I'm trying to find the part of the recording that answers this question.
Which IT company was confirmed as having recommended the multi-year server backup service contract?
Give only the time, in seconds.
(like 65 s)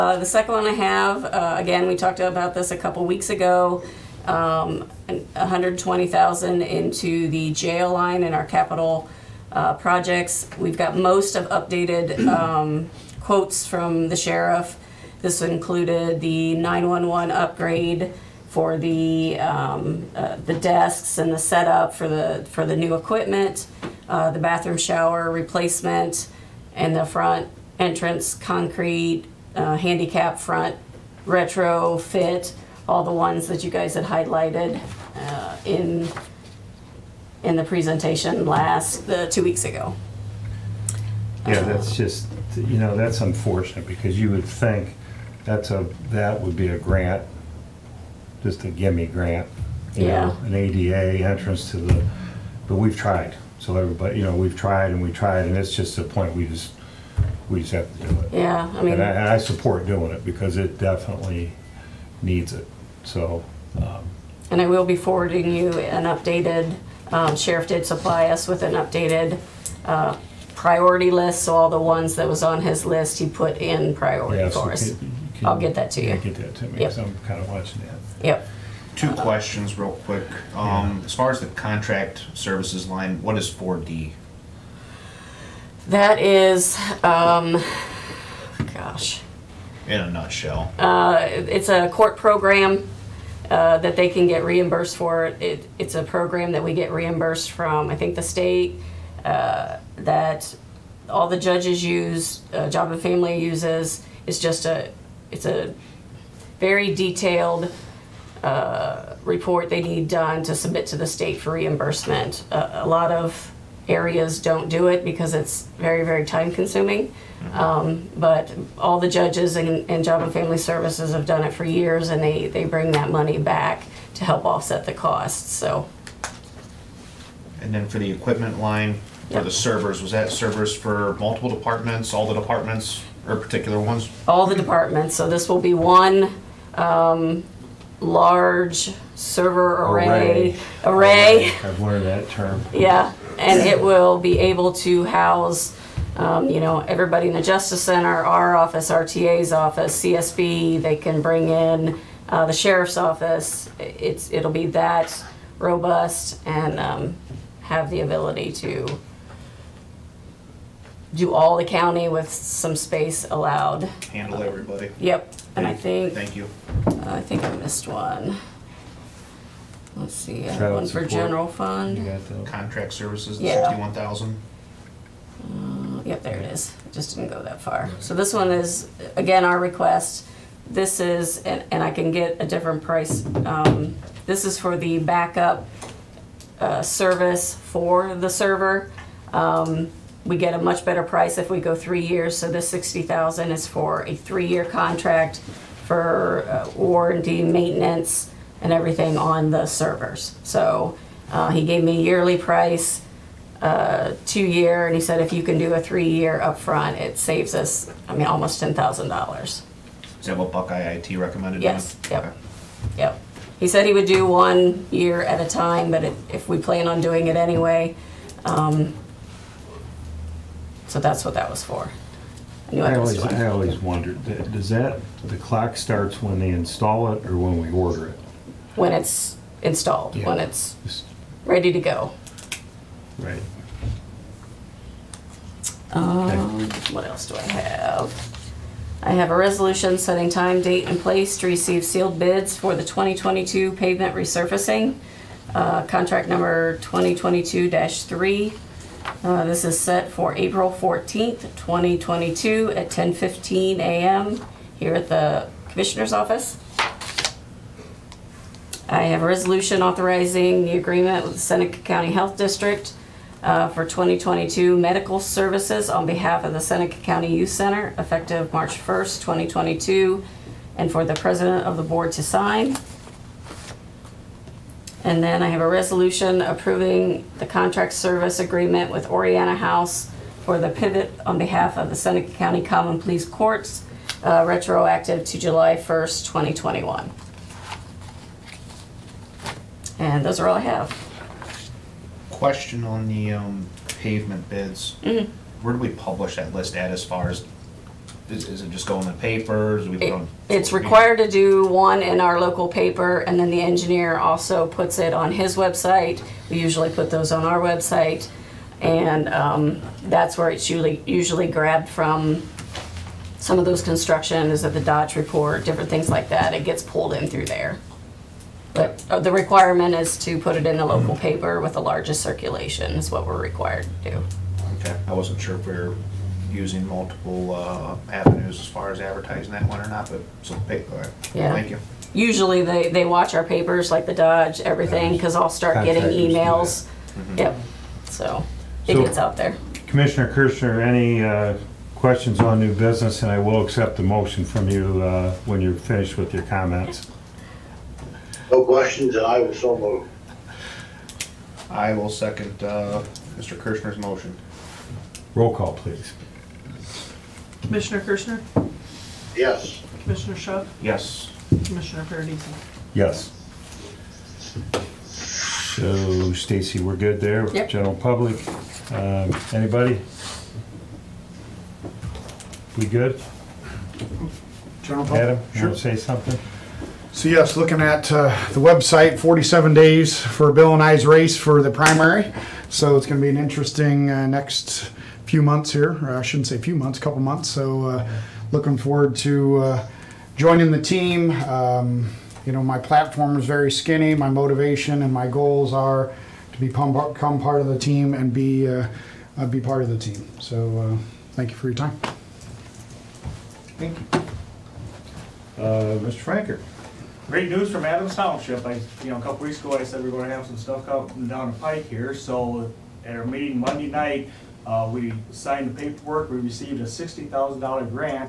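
210 s.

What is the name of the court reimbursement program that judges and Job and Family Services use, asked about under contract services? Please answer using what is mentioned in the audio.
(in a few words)
Four D.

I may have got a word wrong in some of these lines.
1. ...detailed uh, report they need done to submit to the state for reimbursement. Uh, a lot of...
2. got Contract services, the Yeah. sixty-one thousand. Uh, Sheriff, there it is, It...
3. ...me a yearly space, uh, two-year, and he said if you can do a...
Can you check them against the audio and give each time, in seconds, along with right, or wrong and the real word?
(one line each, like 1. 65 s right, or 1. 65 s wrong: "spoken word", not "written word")
1. 106 s right
2. 172 s wrong: "Yep", not "Sheriff"
3. 201 s wrong: "price", not "space".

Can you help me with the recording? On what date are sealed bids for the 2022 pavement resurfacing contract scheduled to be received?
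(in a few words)
April 14, 2022.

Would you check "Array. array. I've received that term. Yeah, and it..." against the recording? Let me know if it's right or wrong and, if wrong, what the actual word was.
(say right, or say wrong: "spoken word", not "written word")
wrong: "learned", not "received".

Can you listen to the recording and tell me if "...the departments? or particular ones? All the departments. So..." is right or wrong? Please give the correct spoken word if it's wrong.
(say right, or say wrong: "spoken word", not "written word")
right.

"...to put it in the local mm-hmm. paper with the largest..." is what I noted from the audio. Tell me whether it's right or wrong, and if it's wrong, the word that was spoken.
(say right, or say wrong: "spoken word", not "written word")
right.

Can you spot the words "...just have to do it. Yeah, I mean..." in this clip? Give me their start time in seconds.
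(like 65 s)
57 s.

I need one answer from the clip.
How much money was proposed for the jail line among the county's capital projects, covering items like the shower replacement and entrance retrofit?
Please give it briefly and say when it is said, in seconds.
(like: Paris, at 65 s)
$120,000, at 5 s.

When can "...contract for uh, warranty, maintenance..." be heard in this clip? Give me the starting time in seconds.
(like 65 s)
194 s.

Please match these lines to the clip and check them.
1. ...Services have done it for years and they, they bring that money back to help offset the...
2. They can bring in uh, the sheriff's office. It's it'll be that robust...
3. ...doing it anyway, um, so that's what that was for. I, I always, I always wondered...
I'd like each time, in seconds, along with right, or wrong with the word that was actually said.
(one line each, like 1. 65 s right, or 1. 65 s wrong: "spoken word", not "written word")
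1. 120 s right
2. 150 s right
3. 217 s right.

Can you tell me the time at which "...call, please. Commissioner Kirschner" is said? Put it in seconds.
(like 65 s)
355 s.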